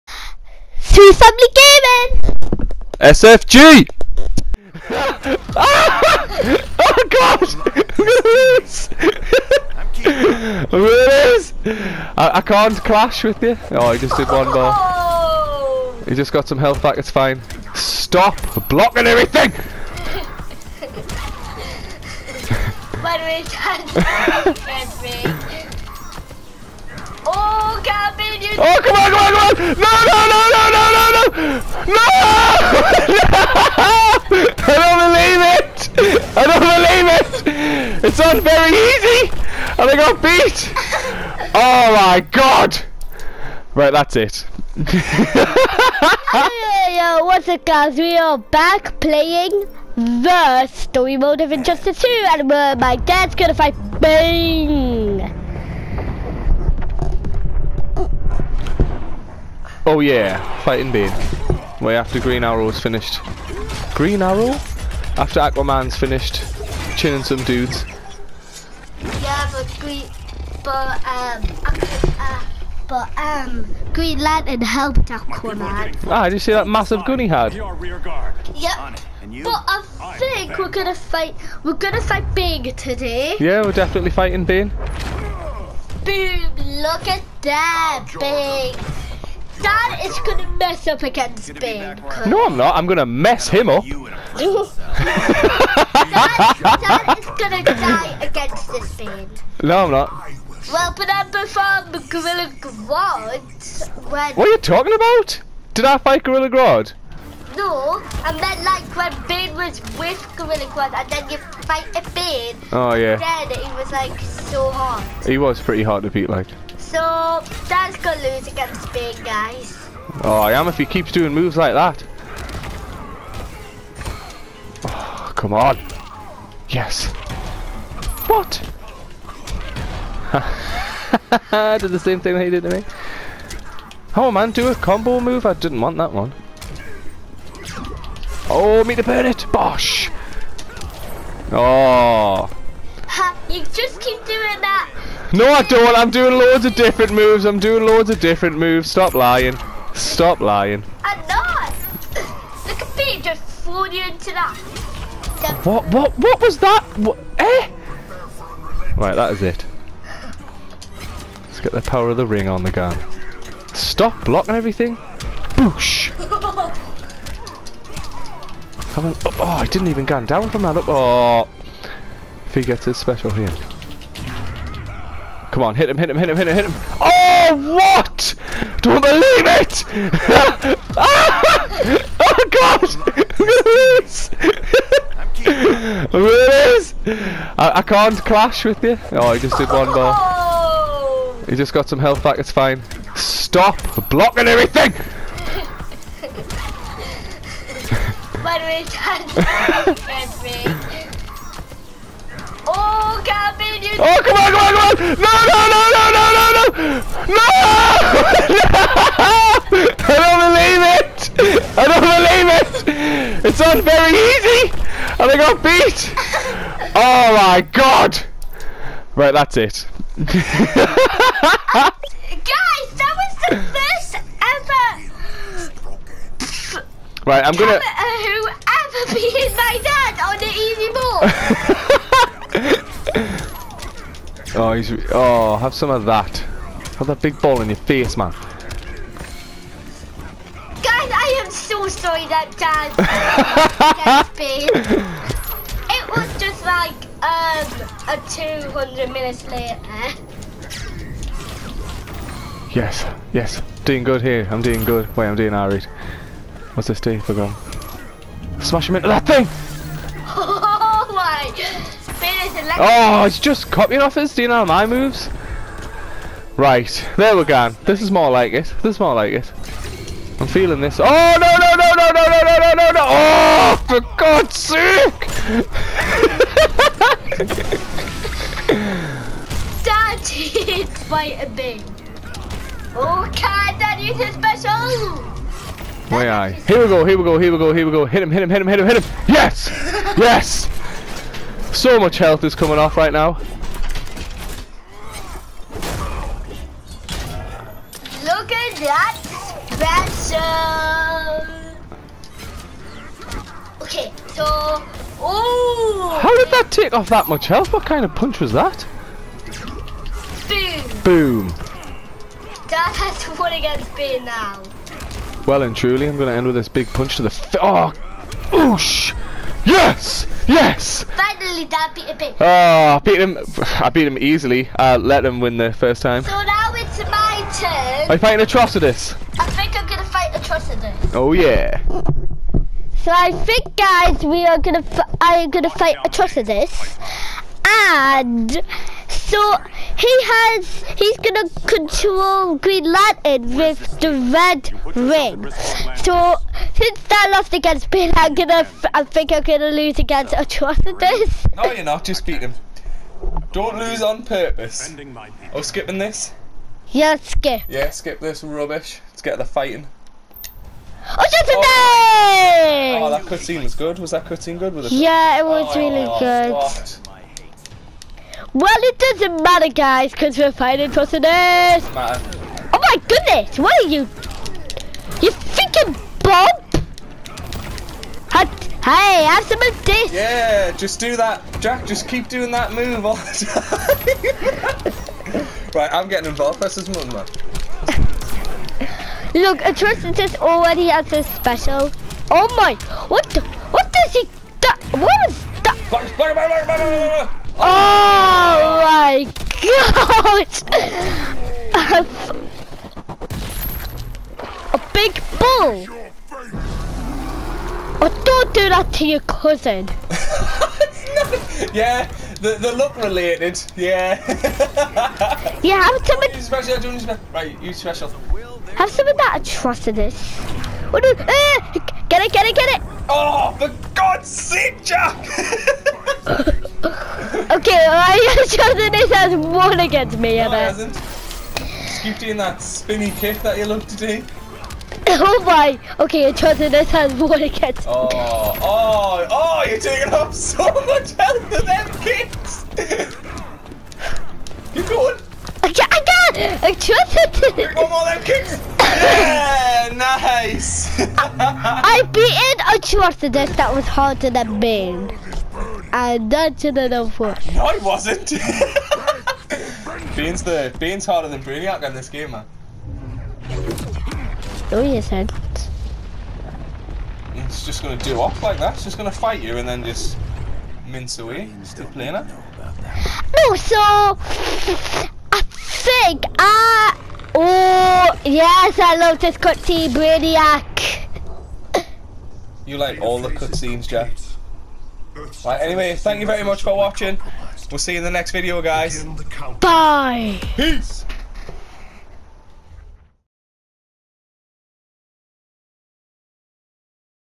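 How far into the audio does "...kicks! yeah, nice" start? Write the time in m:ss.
7:28.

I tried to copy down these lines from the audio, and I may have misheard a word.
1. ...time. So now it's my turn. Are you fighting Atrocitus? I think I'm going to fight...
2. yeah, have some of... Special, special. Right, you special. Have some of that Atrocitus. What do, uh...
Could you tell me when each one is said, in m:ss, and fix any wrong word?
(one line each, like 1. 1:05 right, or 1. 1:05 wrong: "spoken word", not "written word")
1. 5:26 right
2. 6:55 right.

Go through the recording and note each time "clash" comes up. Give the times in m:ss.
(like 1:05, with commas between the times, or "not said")
0:12, 3:08.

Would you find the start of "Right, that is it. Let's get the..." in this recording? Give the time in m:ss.
2:38.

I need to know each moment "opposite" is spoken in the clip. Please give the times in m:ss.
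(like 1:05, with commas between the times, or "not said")
not said.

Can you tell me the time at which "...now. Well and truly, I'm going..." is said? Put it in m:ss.
5:14.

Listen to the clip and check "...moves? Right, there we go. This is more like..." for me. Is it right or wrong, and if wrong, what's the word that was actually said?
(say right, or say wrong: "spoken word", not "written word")
right.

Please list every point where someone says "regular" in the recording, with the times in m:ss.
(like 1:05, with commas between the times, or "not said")
not said.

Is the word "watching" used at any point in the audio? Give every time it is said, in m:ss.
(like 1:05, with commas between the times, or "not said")
8:06.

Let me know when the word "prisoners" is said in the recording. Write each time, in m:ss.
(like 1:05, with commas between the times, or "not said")
6:10.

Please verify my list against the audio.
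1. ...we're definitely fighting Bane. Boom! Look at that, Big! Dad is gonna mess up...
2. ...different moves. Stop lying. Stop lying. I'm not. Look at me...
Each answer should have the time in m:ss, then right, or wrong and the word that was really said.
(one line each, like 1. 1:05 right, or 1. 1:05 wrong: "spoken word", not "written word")
1. 1:23 right
2. 2:28 right.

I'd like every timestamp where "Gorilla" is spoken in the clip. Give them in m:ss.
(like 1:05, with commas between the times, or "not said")
1:42, 1:46, 1:50.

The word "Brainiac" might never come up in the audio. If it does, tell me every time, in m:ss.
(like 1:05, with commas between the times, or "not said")
7:41, 7:59.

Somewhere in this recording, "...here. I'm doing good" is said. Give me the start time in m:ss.
4:14.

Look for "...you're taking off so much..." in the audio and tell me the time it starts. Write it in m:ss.
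7:19.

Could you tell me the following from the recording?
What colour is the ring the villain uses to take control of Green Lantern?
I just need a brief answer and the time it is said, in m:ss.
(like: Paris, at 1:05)
red, at 5:43.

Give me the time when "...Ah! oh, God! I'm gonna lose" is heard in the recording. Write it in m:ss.
3:00.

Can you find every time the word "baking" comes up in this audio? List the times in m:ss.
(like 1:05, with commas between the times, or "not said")
not said.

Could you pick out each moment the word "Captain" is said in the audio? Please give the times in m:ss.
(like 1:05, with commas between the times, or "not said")
0:27, 3:23.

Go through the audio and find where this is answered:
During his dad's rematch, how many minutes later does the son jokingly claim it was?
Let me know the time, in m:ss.
4:08.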